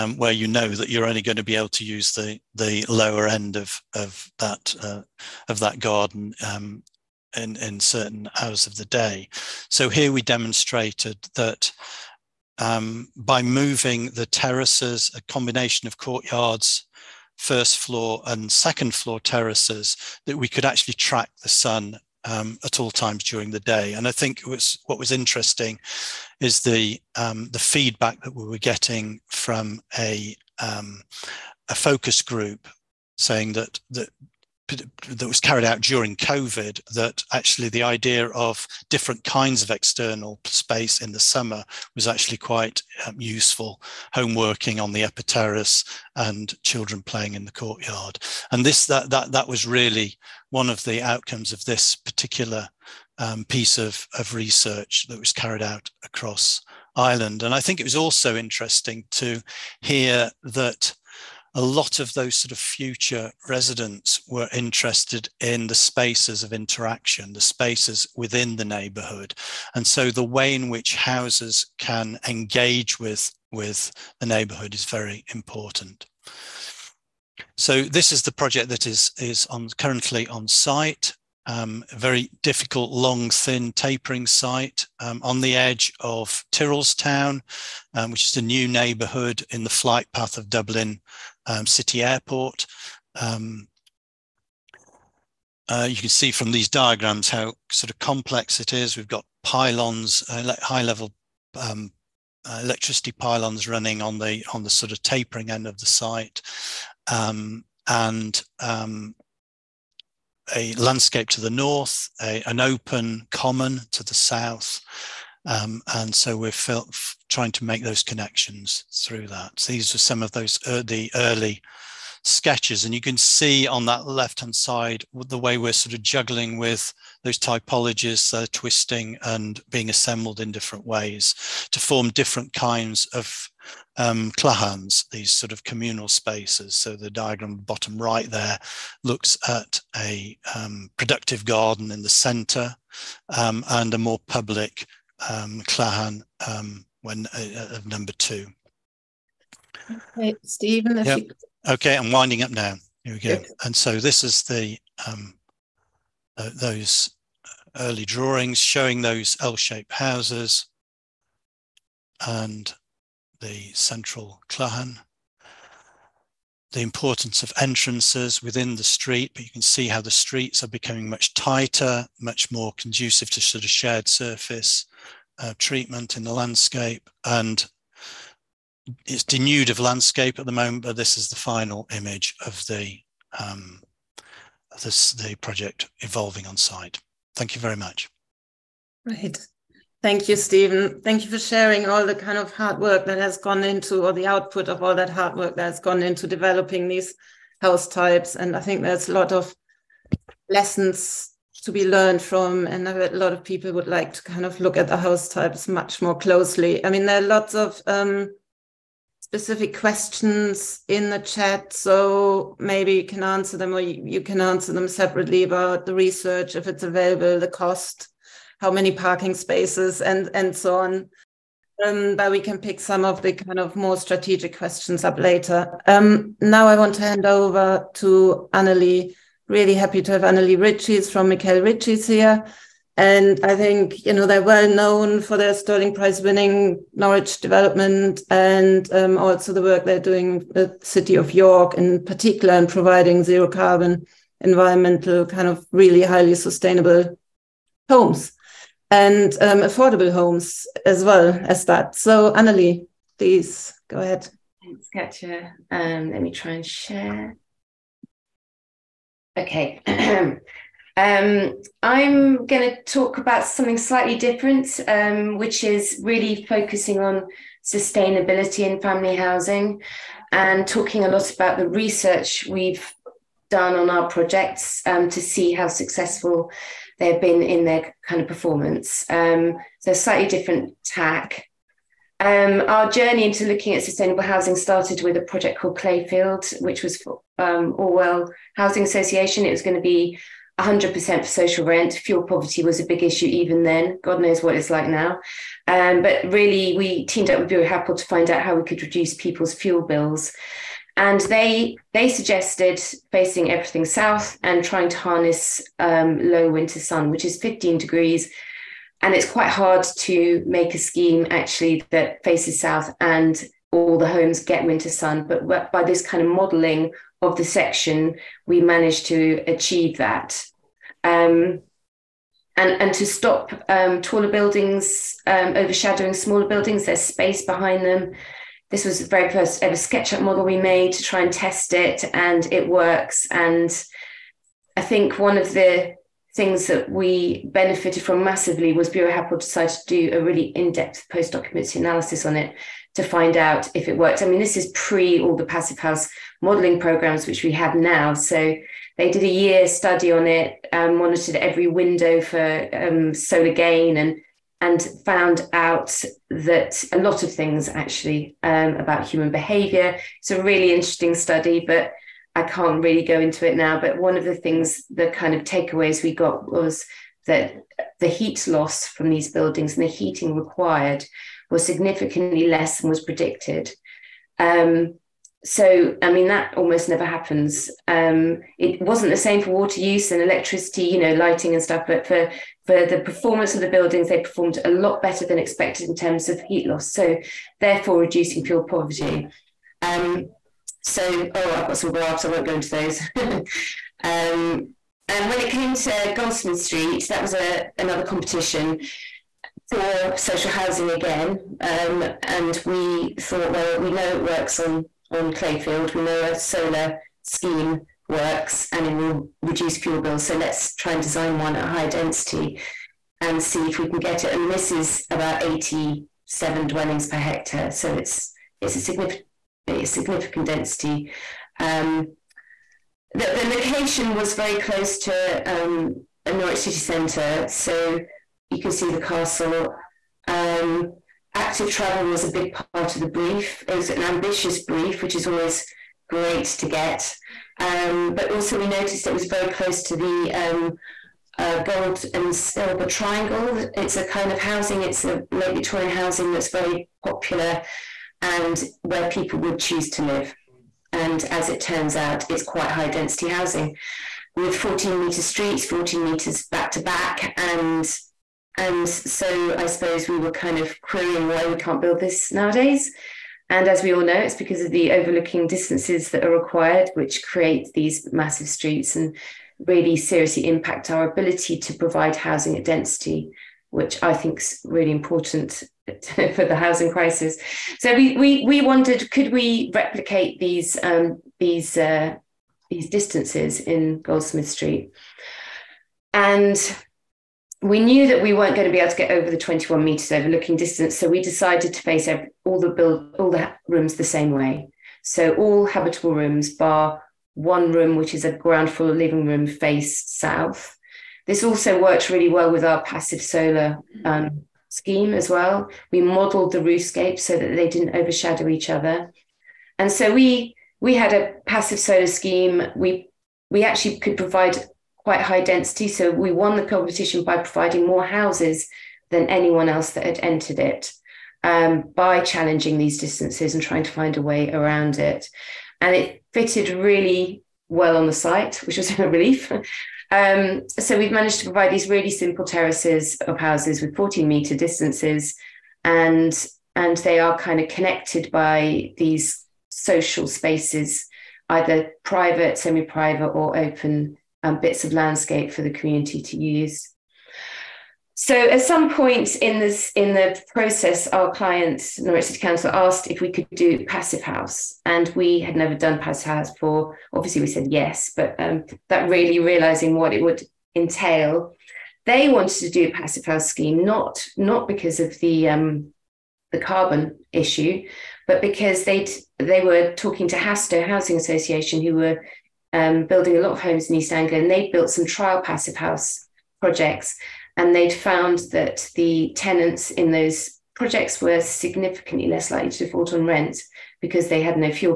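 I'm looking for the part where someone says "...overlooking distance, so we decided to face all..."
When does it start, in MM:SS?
08:10.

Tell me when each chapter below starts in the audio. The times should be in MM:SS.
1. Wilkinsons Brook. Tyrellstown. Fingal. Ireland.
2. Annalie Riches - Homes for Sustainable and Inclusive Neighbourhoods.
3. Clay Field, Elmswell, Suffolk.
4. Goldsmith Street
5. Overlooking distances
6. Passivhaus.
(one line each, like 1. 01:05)
1. 01:16
2. 03:46
3. 04:41
4. 06:35
5. 07:33
6. 09:07.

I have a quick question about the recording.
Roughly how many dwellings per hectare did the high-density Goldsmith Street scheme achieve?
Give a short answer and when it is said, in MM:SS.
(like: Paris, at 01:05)
87, at 06:55.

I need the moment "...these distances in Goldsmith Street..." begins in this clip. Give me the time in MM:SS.
08:02.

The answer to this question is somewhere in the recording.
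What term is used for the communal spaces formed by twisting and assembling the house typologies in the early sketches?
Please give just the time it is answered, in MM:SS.
02:14.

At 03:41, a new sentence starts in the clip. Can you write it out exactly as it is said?
Um, but we can pick some of the kind of more strategic questions up later.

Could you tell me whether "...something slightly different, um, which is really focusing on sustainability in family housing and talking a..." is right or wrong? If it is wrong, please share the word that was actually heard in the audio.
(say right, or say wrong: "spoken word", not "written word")
right.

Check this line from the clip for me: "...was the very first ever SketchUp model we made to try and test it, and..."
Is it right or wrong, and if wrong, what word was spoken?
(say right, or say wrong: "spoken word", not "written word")
right.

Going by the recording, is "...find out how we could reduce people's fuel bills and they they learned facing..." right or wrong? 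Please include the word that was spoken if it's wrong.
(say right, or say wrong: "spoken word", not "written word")
wrong: "suggested", not "learned".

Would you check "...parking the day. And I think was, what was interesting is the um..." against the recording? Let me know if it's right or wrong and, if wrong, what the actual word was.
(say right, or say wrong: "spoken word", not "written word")
wrong: "during", not "parking".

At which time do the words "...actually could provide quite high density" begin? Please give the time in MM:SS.
08:33.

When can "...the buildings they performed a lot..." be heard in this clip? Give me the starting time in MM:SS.
06:23.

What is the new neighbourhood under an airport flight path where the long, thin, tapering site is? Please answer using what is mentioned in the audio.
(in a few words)
Tyrrellstown.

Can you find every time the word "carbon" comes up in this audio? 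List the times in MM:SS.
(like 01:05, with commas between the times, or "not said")
04:03, 09:26.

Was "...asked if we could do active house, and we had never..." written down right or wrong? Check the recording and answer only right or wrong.
wrong.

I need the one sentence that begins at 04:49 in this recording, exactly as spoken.
It was going to be 100% for social rent.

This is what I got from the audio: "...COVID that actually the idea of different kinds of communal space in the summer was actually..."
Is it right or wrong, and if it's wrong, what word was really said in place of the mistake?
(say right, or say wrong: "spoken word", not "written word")
wrong: "external", not "communal".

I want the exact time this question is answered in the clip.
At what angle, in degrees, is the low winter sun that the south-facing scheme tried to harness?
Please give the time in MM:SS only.
05:07.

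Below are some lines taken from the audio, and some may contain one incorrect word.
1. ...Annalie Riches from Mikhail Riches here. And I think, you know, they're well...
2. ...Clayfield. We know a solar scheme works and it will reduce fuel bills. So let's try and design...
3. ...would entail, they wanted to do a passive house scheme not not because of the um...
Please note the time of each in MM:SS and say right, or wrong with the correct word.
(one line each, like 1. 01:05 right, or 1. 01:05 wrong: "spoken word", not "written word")
1. 03:50 right
2. 06:45 right
3. 09:20 right.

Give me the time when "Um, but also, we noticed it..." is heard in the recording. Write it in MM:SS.
07:17.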